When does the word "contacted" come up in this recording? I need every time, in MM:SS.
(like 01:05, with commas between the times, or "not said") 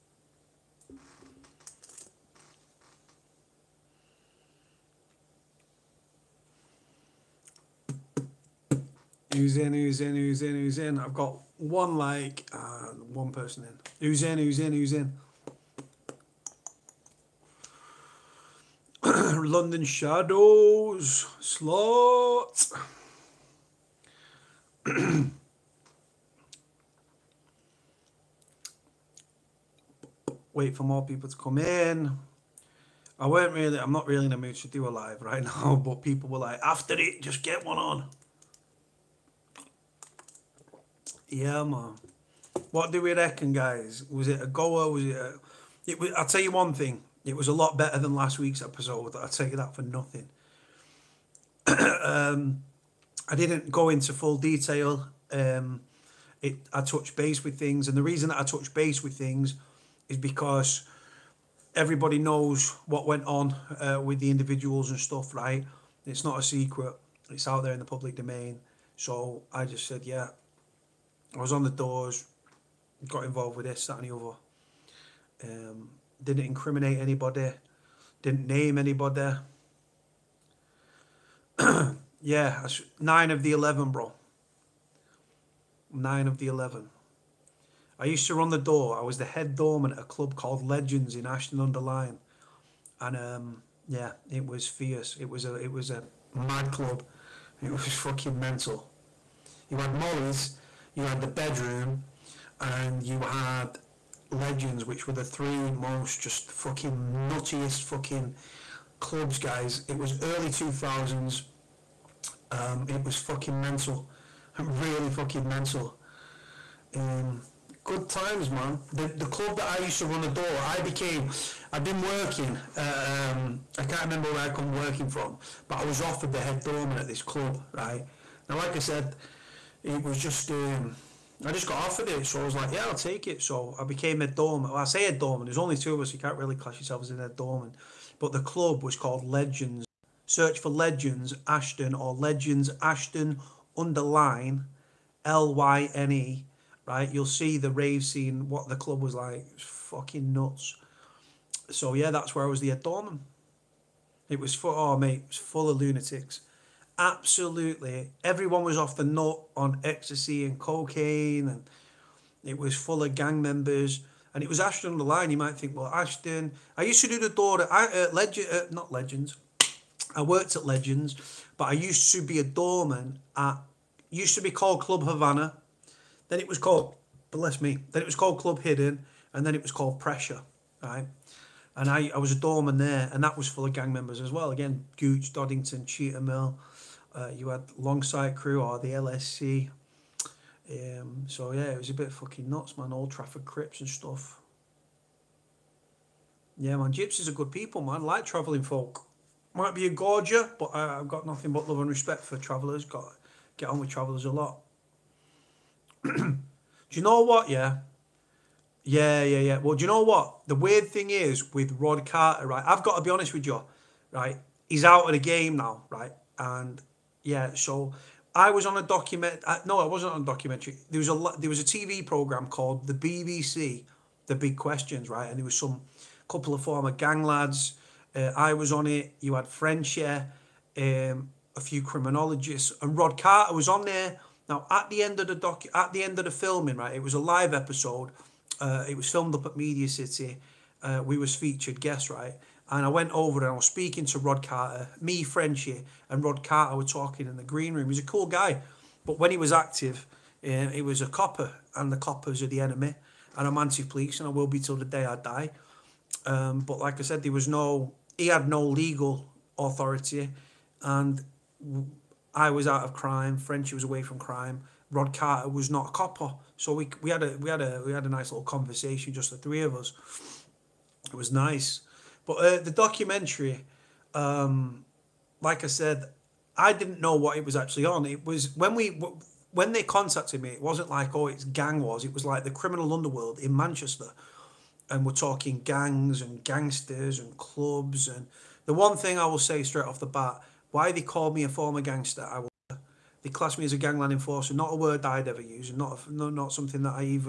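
04:39.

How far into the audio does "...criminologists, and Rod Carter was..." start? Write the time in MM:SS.
03:51.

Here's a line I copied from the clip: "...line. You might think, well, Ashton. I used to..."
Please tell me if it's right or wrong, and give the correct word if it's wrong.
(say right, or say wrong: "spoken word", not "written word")
right.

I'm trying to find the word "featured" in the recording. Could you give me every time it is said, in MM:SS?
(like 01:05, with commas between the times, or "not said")
04:01.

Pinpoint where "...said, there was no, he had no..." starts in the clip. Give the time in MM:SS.
04:17.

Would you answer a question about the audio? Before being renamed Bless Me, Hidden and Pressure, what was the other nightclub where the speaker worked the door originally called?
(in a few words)
Club Havana.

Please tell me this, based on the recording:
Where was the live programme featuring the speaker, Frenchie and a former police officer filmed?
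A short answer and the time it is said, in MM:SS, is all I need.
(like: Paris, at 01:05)
Media City, at 03:59.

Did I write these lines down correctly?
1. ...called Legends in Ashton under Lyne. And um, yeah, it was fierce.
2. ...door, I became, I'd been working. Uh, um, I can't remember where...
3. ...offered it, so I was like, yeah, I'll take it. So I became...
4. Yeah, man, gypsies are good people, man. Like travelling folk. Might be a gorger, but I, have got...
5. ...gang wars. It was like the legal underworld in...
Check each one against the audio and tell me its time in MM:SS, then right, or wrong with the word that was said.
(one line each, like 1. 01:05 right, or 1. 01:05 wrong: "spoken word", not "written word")
1. 01:30 right
2. 02:00 right
3. 02:11 right
4. 03:16 right
5. 04:41 wrong: "criminal", not "legal".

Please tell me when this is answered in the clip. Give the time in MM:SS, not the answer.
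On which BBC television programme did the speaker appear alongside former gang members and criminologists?
03:44.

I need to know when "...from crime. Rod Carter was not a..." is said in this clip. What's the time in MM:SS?
04:24.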